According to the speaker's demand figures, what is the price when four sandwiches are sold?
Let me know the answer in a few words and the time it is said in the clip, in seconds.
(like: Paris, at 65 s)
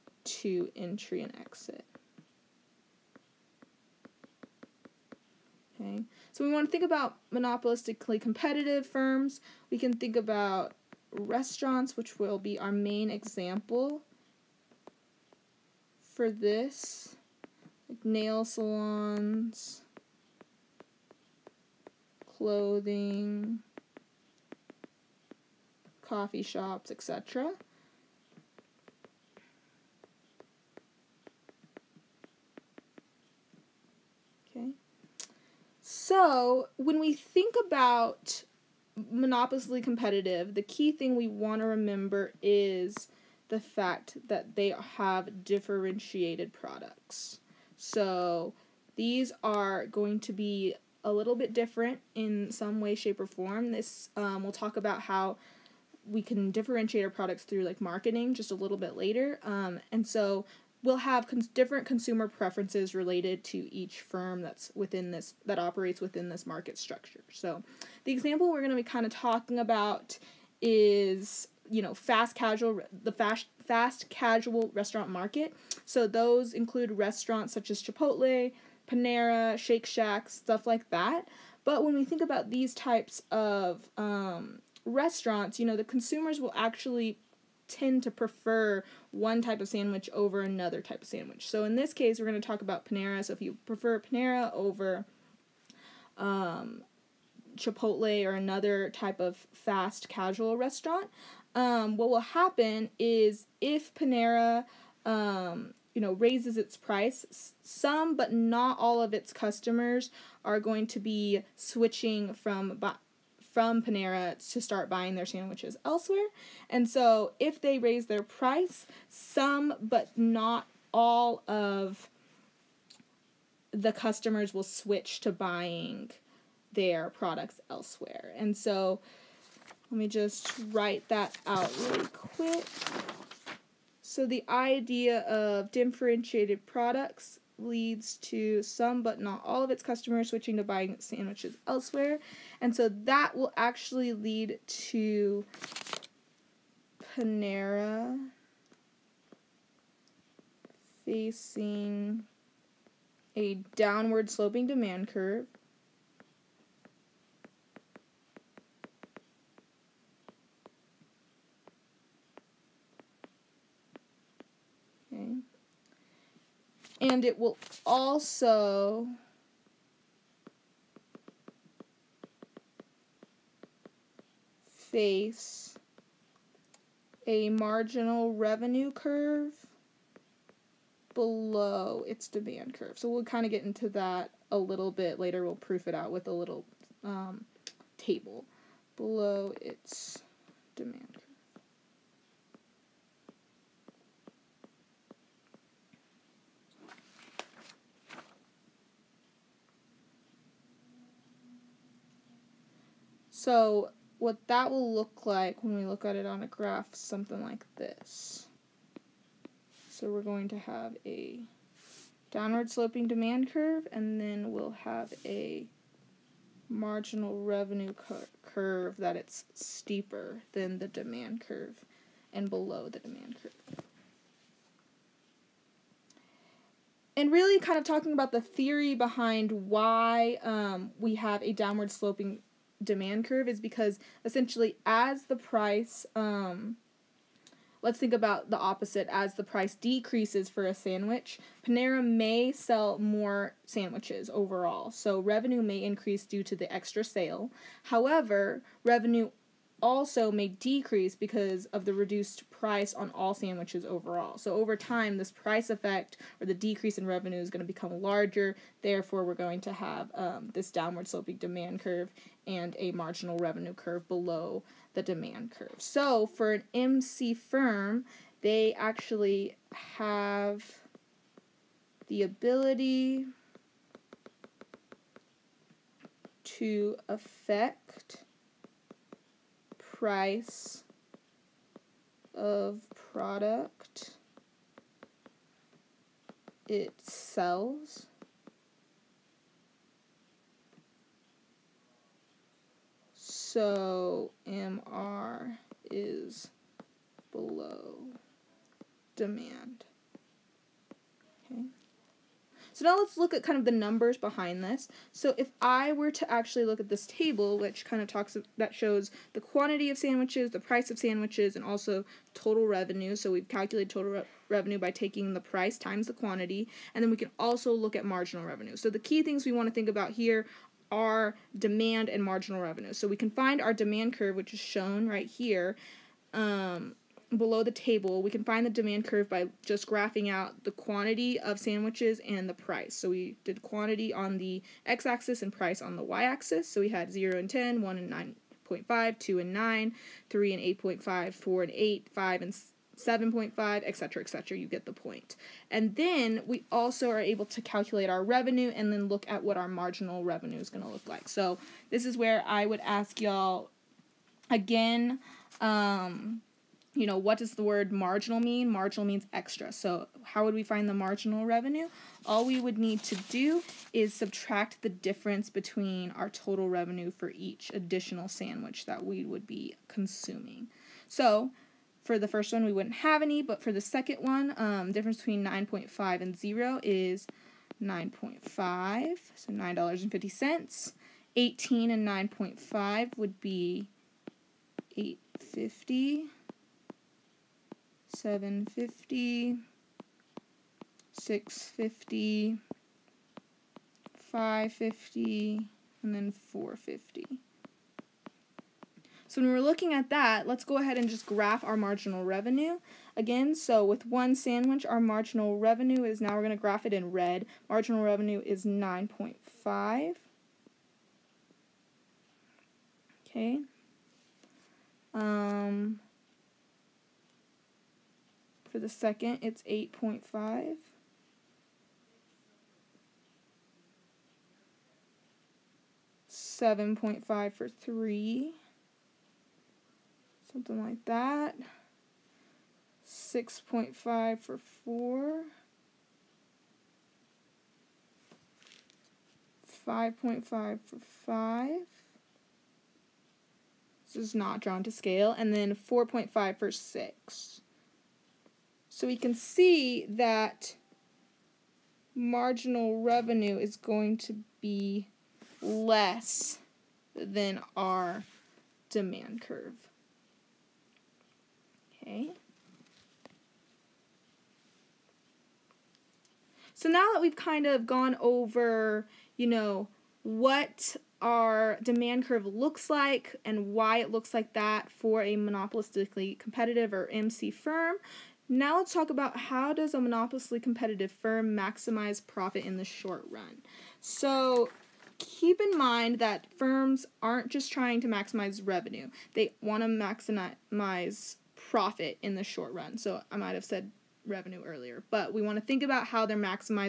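$8, at 341 s.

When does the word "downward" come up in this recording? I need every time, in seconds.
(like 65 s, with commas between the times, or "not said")
153 s, 212 s, 231 s, 260 s.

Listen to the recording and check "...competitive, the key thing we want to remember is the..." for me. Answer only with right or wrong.
right.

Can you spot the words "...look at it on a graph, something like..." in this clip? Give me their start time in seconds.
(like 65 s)
205 s.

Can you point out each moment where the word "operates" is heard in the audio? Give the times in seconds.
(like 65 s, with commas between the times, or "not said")
65 s.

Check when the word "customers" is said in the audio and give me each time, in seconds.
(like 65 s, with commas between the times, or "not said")
109 s, 123 s, 139 s.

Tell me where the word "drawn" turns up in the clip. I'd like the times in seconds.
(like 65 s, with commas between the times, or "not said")
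444 s.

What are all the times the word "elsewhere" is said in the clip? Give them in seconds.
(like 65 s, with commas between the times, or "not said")
115 s, 127 s, 141 s.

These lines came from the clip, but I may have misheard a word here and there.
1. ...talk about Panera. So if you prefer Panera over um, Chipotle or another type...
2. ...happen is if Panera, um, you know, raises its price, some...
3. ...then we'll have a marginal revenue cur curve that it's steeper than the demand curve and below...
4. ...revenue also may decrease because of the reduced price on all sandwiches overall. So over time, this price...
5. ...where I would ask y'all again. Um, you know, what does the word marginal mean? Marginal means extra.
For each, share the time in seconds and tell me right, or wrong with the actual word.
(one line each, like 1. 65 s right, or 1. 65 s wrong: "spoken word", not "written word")
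1. 92 s right
2. 102 s right
3. 214 s right
4. 248 s right
5. 352 s right.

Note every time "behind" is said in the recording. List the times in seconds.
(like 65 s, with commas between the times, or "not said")
228 s, 304 s.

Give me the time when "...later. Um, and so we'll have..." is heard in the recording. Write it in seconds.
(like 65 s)
58 s.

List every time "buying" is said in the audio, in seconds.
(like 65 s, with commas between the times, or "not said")
114 s, 125 s, 140 s.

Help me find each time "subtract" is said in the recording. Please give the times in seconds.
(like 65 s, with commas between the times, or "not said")
364 s.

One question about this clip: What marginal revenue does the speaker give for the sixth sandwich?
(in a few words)
$4.50.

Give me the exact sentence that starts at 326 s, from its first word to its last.
Um, below the table, we can find the demand curve by just graphing out the quantity of sandwiches and the price.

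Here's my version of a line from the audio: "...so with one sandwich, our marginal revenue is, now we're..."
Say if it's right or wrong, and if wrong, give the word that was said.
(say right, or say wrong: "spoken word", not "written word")
right.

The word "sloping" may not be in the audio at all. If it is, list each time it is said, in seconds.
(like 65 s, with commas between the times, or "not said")
154 s, 212 s, 231 s, 261 s.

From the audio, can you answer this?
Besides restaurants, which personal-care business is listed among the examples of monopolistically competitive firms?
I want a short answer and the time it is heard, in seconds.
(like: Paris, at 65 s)
nail salons, at 18 s.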